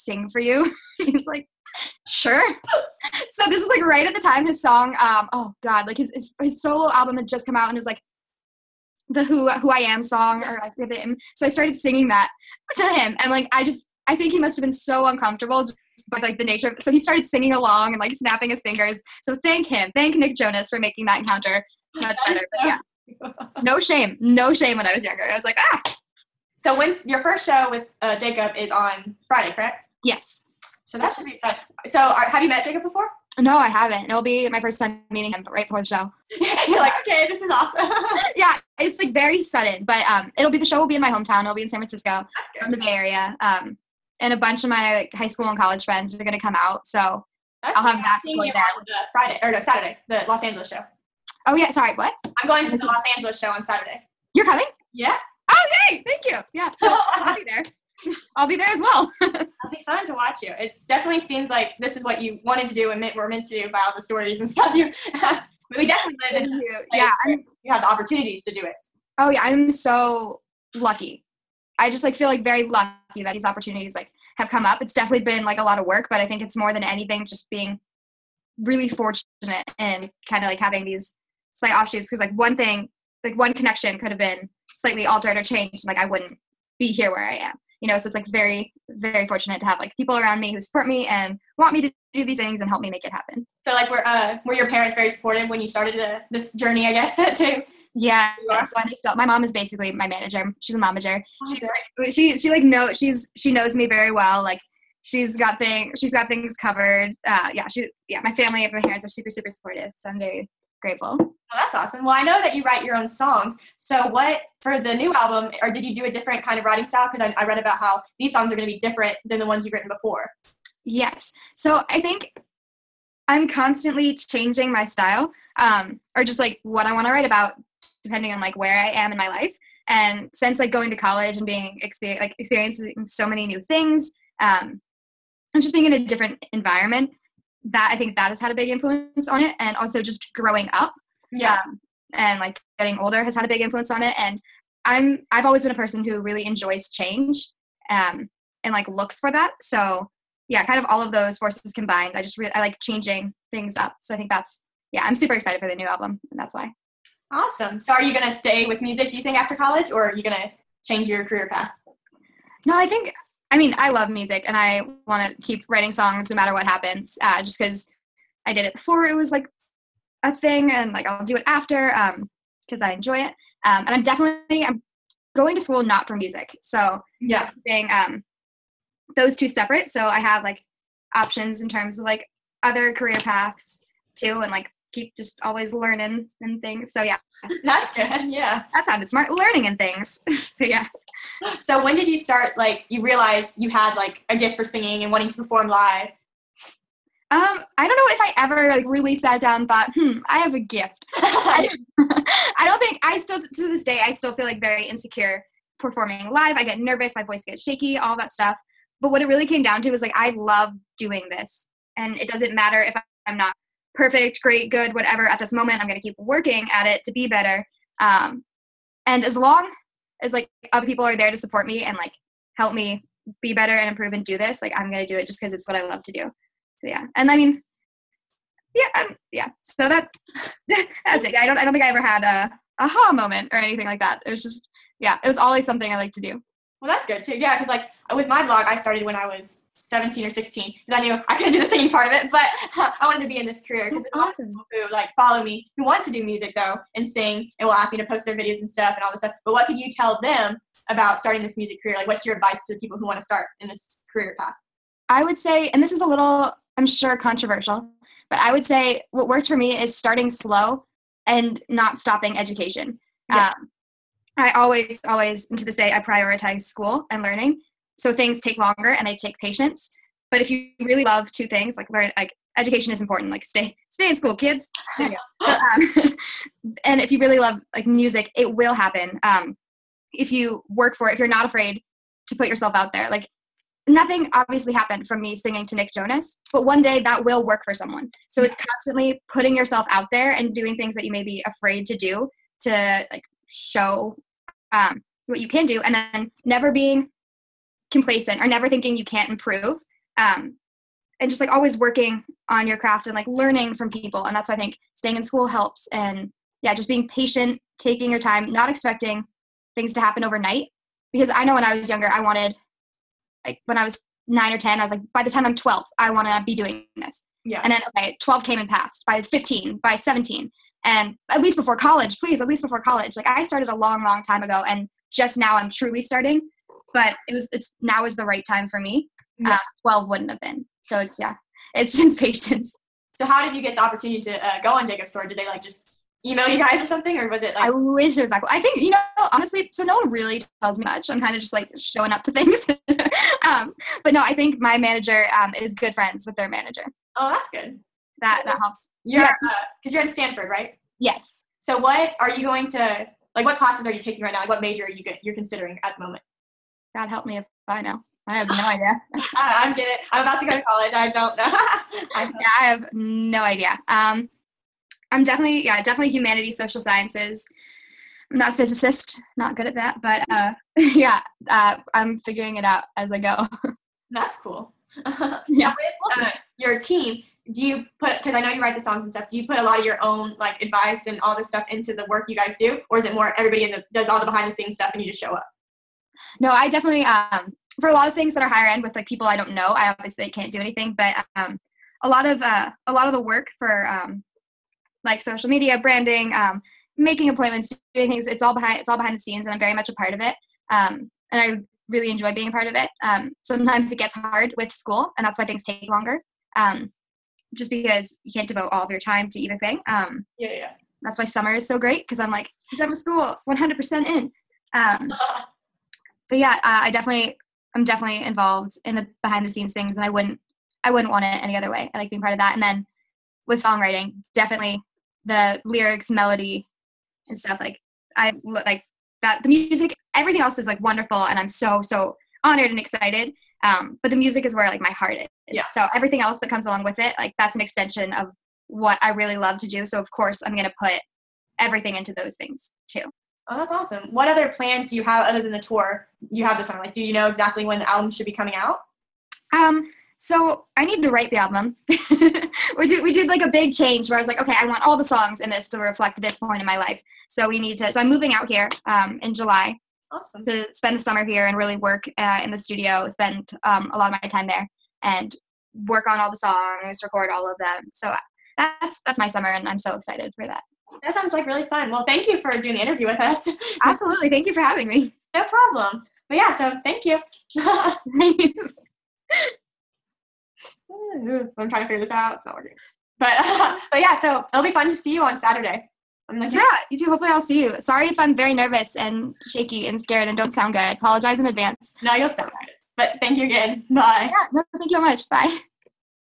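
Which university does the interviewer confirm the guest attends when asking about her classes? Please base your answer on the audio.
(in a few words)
Stanford.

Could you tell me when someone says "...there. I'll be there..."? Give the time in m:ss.
0:57.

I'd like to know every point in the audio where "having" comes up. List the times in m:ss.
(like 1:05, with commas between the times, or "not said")
1:20, 7:54.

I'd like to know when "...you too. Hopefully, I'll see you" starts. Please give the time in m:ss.
8:06.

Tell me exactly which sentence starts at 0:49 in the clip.
Friday or no Saturday, the Los Angeles show.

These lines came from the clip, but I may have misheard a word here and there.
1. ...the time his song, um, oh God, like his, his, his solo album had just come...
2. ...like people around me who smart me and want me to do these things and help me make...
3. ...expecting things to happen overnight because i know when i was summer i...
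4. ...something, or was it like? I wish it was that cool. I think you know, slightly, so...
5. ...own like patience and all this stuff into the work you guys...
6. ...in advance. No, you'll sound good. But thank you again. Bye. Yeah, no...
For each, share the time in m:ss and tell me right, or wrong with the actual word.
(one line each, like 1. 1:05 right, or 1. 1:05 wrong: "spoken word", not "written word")
1. 0:04 right
2. 1:29 wrong: "support", not "smart"
3. 5:08 wrong: "younger", not "summer"
4. 5:36 wrong: "honestly", not "slightly"
5. 6:20 wrong: "advice", not "patience"
6. 8:11 right.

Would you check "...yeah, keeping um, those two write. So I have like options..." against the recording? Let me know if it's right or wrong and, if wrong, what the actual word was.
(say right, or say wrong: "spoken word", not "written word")
wrong: "separate", not "write".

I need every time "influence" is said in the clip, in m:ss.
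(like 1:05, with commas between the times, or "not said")
2:18, 2:23.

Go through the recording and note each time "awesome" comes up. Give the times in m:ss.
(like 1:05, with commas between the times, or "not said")
0:37, 1:51, 2:37, 4:04, 7:23, 7:40.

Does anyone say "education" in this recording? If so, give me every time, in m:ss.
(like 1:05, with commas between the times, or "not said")
4:22, 4:32.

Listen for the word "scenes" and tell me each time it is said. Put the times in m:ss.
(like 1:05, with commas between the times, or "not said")
6:24, 6:39, 6:59.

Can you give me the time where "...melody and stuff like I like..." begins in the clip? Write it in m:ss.
7:06.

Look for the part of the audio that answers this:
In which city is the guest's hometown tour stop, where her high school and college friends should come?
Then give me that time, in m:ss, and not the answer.
0:41.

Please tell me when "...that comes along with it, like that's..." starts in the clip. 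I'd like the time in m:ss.
7:16.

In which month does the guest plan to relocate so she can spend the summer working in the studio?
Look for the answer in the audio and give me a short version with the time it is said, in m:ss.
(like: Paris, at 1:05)
July, at 7:39.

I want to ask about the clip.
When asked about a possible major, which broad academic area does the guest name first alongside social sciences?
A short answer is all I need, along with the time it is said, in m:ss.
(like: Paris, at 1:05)
Humanities, at 6:06.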